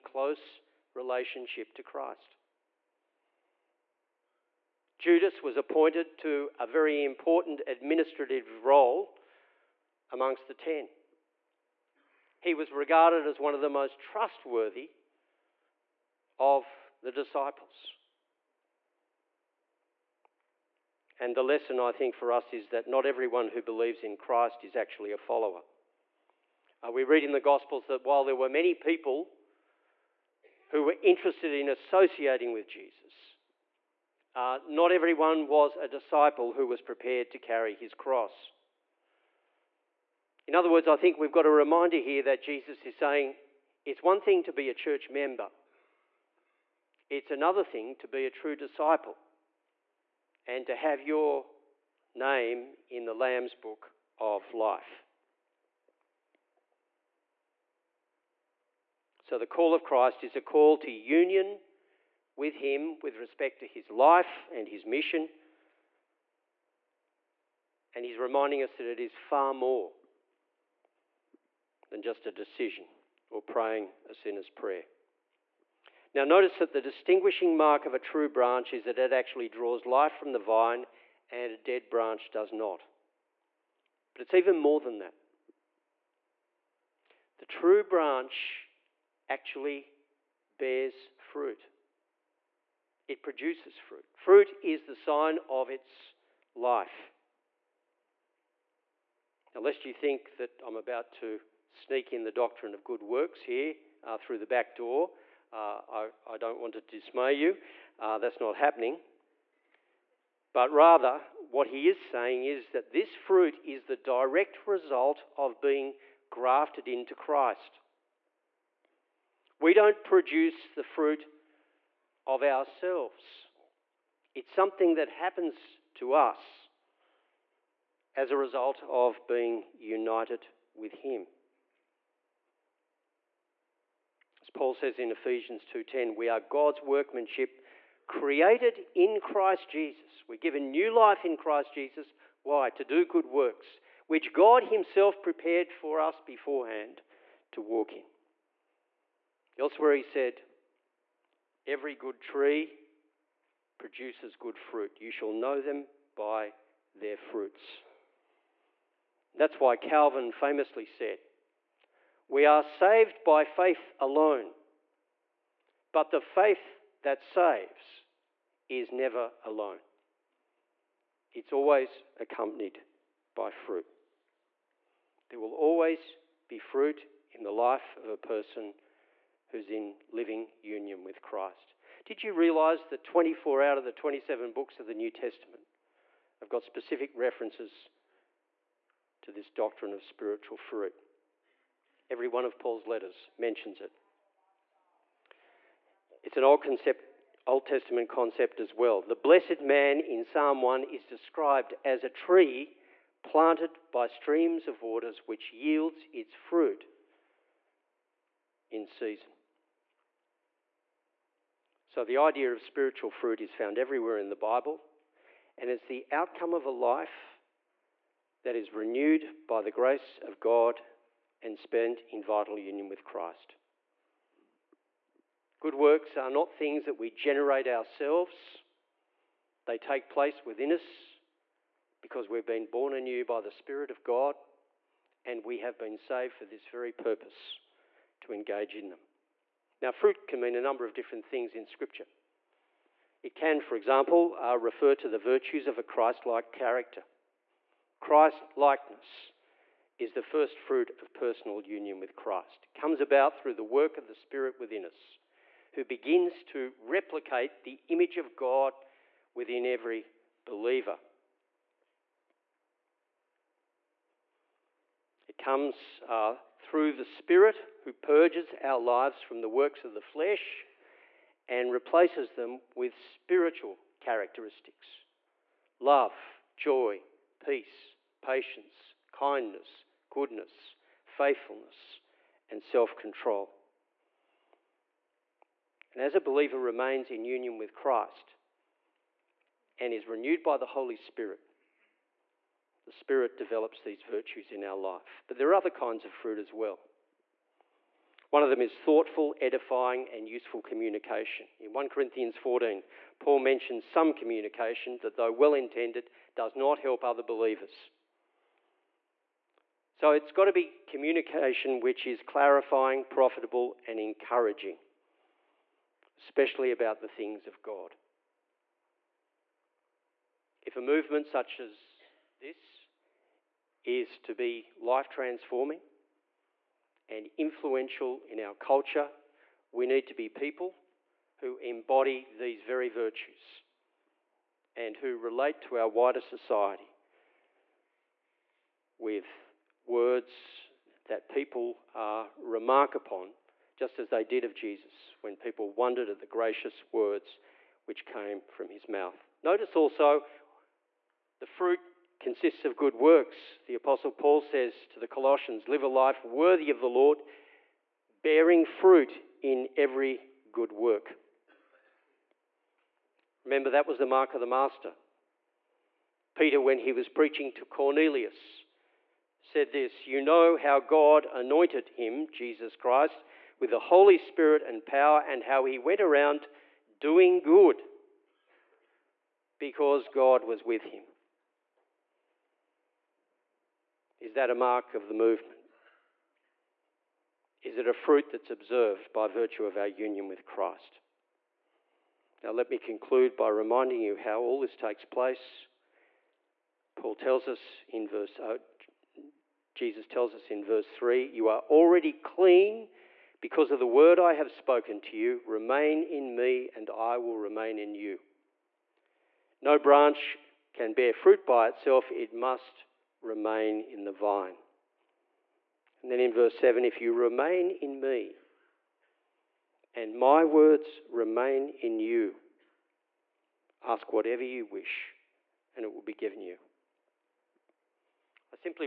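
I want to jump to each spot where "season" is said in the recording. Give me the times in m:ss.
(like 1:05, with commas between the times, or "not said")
3:28.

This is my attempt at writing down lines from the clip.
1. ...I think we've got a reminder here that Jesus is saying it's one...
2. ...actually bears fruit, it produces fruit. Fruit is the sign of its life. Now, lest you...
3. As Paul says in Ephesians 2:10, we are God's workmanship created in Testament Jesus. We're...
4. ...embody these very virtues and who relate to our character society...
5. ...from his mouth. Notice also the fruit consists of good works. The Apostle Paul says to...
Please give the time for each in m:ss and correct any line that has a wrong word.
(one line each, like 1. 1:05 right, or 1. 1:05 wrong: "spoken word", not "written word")
1. 0:40 right
2. 1:29 right
3. 2:14 wrong: "Christ", not "Testament"
4. 5:31 wrong: "wider", not "character"
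5. 5:48 right.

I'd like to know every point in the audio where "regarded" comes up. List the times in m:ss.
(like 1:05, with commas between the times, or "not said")
0:12.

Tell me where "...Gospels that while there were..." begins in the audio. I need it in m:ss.
0:27.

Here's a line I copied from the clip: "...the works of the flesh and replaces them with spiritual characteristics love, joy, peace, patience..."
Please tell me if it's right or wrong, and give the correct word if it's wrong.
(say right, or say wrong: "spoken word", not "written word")
right.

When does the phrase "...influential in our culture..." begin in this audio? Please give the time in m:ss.
5:27.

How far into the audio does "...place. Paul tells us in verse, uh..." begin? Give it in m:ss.
6:35.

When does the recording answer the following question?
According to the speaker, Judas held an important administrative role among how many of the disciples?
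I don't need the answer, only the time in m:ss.
0:10.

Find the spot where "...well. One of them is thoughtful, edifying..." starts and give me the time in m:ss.
4:56.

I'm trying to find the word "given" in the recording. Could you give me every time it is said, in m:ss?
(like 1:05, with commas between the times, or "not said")
2:20, 7:06.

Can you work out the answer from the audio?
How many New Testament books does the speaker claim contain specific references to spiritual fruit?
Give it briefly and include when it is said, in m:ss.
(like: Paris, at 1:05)
24, at 3:03.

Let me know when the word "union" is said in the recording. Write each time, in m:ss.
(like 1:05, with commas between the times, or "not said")
1:00, 3:00, 3:42, 4:11, 4:47, 6:29.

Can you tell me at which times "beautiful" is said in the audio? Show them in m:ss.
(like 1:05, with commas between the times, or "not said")
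not said.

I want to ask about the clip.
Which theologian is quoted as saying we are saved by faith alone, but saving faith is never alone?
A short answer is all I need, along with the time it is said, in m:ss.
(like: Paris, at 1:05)
Calvin, at 2:39.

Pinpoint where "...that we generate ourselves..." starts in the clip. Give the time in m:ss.
3:46.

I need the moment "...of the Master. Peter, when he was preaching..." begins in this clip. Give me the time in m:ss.
6:04.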